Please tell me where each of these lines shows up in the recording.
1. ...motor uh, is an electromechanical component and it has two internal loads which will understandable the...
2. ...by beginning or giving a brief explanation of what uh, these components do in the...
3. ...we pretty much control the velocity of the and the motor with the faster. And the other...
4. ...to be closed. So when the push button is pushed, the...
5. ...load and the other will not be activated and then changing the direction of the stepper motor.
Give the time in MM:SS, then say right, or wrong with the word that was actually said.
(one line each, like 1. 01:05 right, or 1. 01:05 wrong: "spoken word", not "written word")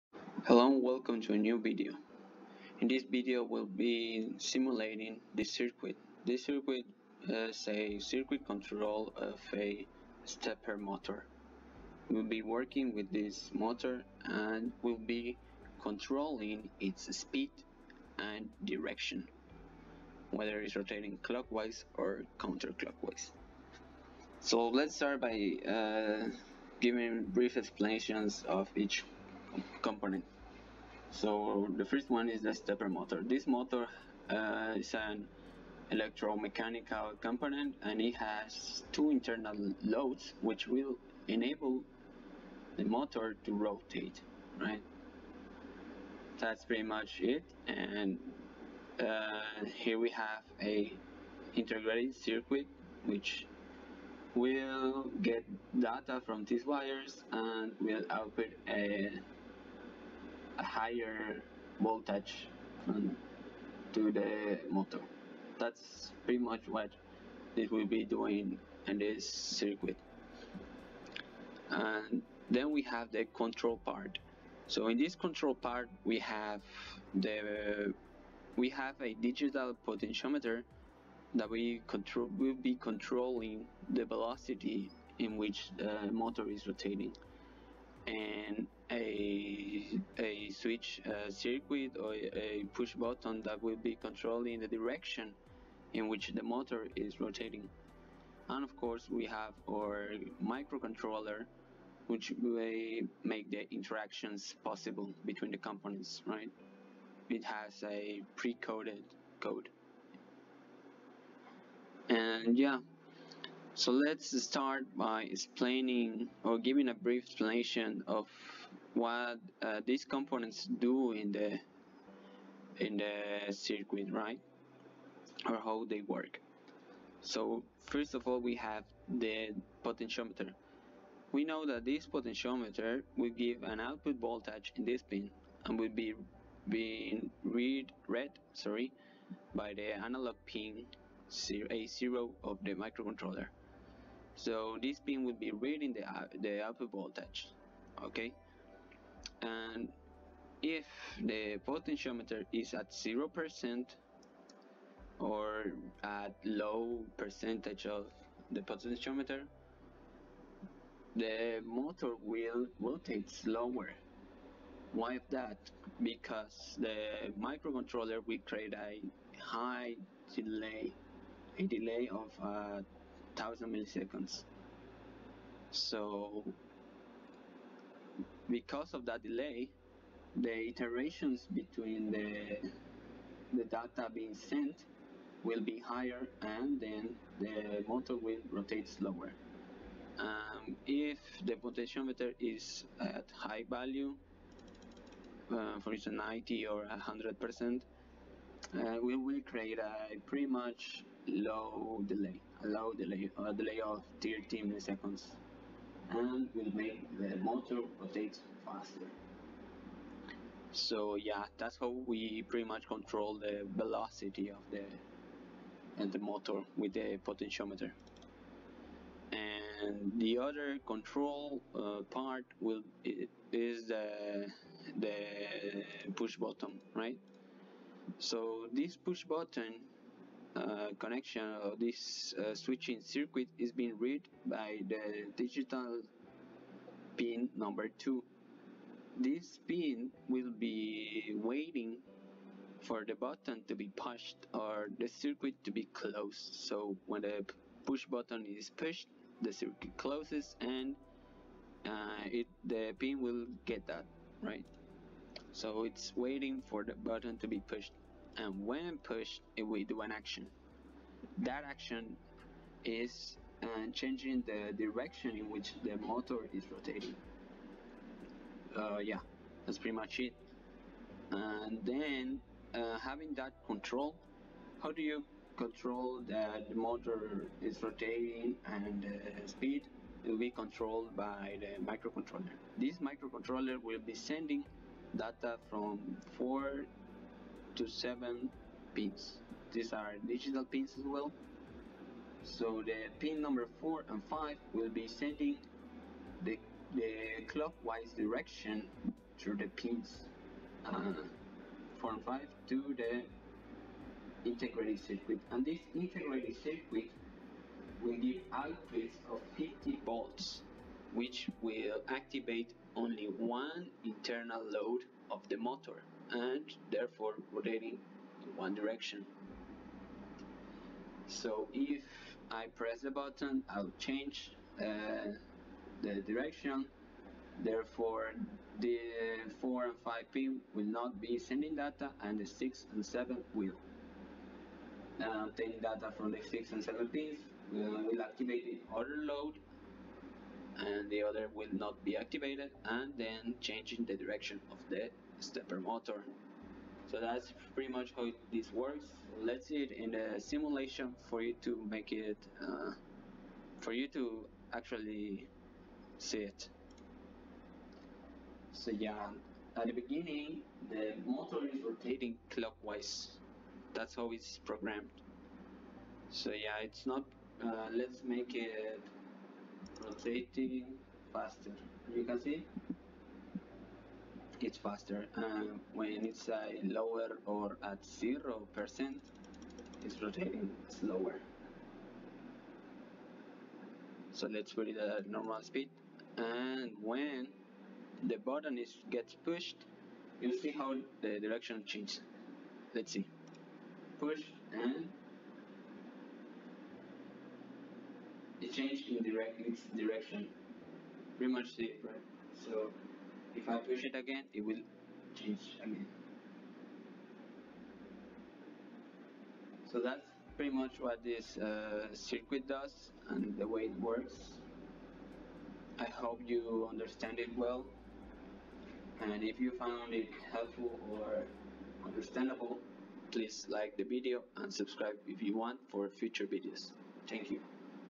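1. 00:33 wrong: "enable", not "understandable"
2. 01:54 wrong: "explaining", not "beginning"
3. 03:32 wrong: "potentiometer", not "faster"
4. 04:05 right
5. 05:39 right.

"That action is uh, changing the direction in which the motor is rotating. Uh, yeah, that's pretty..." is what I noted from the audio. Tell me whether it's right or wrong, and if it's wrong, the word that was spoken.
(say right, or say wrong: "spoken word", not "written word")
right.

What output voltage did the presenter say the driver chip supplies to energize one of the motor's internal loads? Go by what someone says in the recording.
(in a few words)
50 volts.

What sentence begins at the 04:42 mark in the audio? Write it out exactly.
This microcontroller will be sending data from four to seven pins.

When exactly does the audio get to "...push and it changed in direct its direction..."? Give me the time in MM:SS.
06:34.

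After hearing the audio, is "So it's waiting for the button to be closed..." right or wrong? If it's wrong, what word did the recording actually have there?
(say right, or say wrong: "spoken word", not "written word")
wrong: "pushed", not "closed".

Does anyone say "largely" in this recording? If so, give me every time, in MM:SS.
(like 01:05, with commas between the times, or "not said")
not said.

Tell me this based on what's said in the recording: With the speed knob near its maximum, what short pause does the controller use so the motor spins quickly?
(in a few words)
30 milliseconds.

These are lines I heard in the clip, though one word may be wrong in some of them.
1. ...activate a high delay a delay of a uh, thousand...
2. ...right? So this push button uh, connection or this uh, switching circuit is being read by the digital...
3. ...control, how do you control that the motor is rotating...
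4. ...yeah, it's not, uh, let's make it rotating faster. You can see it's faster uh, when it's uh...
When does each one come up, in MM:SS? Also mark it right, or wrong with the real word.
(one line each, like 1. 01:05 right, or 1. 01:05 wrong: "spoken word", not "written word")
1. 02:48 wrong: "create", not "activate"
2. 03:46 right
3. 04:33 right
4. 06:06 right.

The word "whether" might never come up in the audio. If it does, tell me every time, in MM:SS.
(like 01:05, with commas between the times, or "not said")
00:20.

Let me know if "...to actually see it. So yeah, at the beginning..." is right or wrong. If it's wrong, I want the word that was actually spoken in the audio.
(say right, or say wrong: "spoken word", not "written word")
right.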